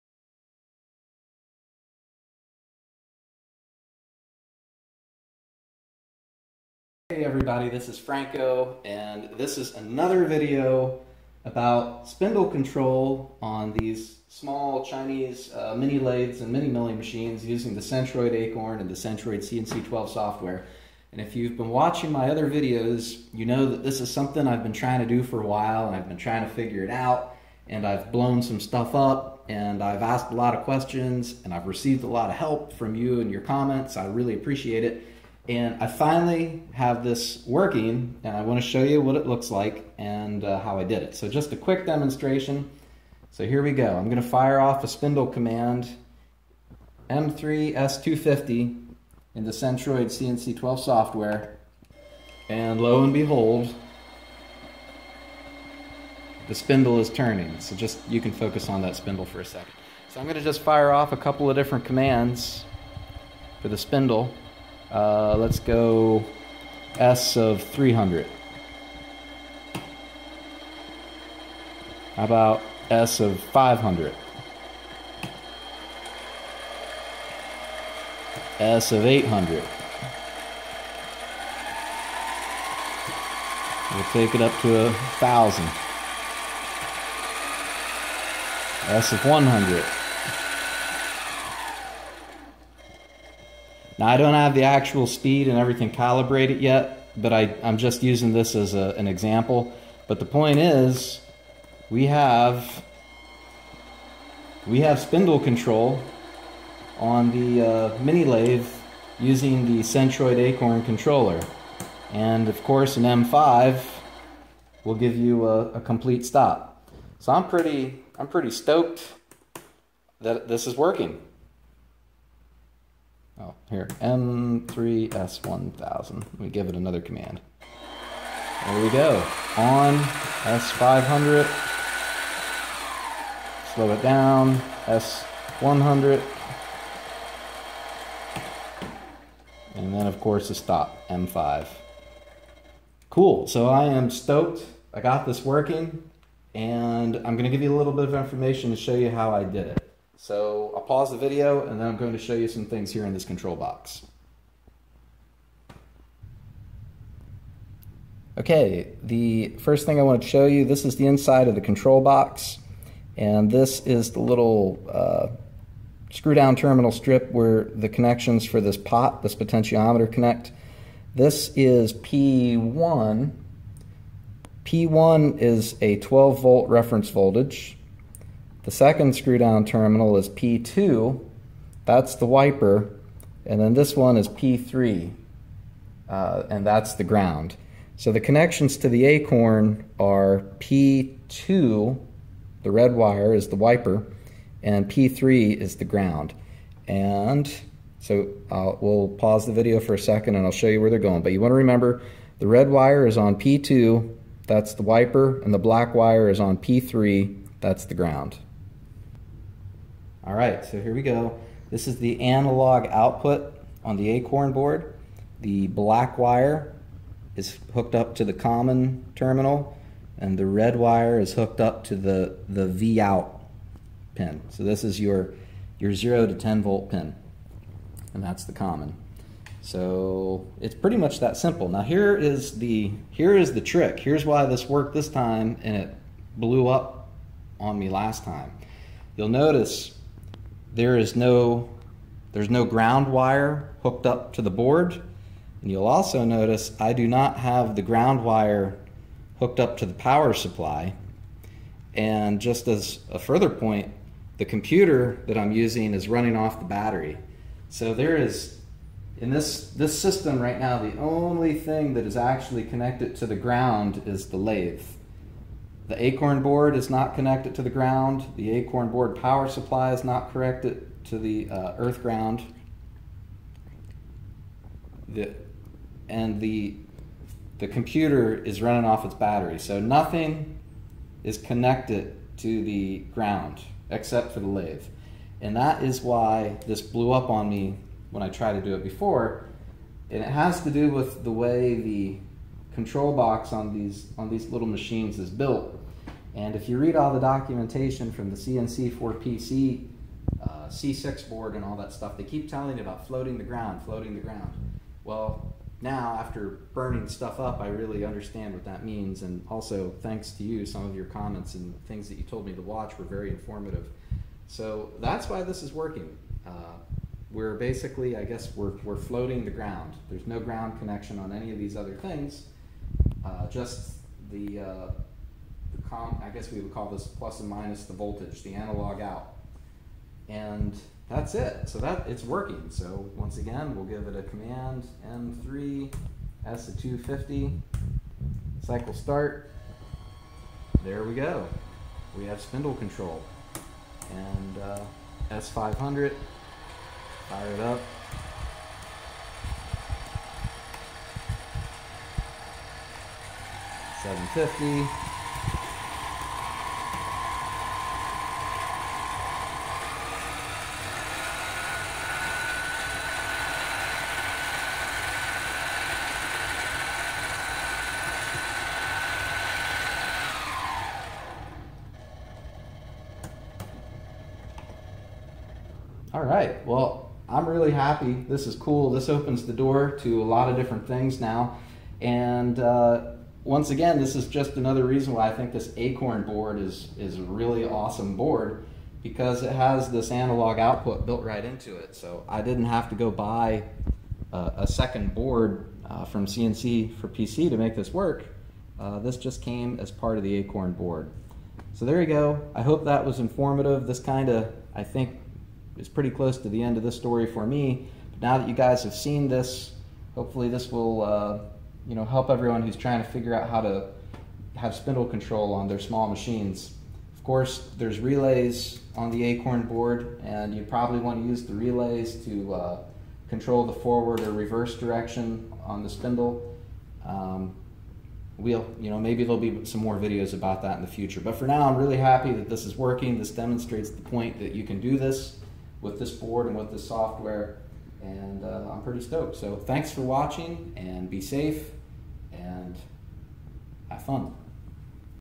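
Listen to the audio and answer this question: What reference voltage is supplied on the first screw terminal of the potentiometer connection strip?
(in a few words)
12 volts.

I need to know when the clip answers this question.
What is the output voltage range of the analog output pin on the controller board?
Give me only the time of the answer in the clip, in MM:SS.
03:45.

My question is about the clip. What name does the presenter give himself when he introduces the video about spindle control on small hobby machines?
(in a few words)
Franco.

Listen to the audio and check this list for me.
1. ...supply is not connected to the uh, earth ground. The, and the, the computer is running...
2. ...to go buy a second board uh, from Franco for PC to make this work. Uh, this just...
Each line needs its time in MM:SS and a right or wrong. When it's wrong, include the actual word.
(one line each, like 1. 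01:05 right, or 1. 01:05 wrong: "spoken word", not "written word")
1. 04:29 right
2. 06:32 wrong: "CNC", not "Franco".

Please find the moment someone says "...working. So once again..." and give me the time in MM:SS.
05:32.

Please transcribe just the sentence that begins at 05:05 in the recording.
Well, now after burning stuff up, I really understand what that means.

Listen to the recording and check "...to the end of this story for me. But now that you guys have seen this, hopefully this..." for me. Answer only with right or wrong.
right.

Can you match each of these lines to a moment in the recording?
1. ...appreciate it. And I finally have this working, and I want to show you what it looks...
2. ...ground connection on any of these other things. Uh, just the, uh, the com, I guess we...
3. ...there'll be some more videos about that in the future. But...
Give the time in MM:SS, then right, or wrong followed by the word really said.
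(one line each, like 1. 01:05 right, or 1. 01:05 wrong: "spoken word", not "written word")
1. 00:34 right
2. 05:20 right
3. 07:09 right.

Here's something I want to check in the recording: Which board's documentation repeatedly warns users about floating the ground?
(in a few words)
C6 board.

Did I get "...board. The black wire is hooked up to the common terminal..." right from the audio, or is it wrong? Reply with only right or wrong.
right.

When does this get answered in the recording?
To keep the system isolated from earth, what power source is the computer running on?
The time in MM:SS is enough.
04:16.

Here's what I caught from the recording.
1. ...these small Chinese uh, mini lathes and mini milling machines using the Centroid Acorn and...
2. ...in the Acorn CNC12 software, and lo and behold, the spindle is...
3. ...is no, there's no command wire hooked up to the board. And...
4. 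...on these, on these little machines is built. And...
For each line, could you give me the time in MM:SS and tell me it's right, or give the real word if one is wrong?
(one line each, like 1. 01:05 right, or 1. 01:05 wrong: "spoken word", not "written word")
1. 00:13 right
2. 00:49 wrong: "Centroid", not "Acorn"
3. 04:00 wrong: "ground", not "command"
4. 04:53 right.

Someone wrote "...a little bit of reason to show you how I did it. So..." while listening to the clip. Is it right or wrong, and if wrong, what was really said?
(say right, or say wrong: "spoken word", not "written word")
wrong: "information", not "reason".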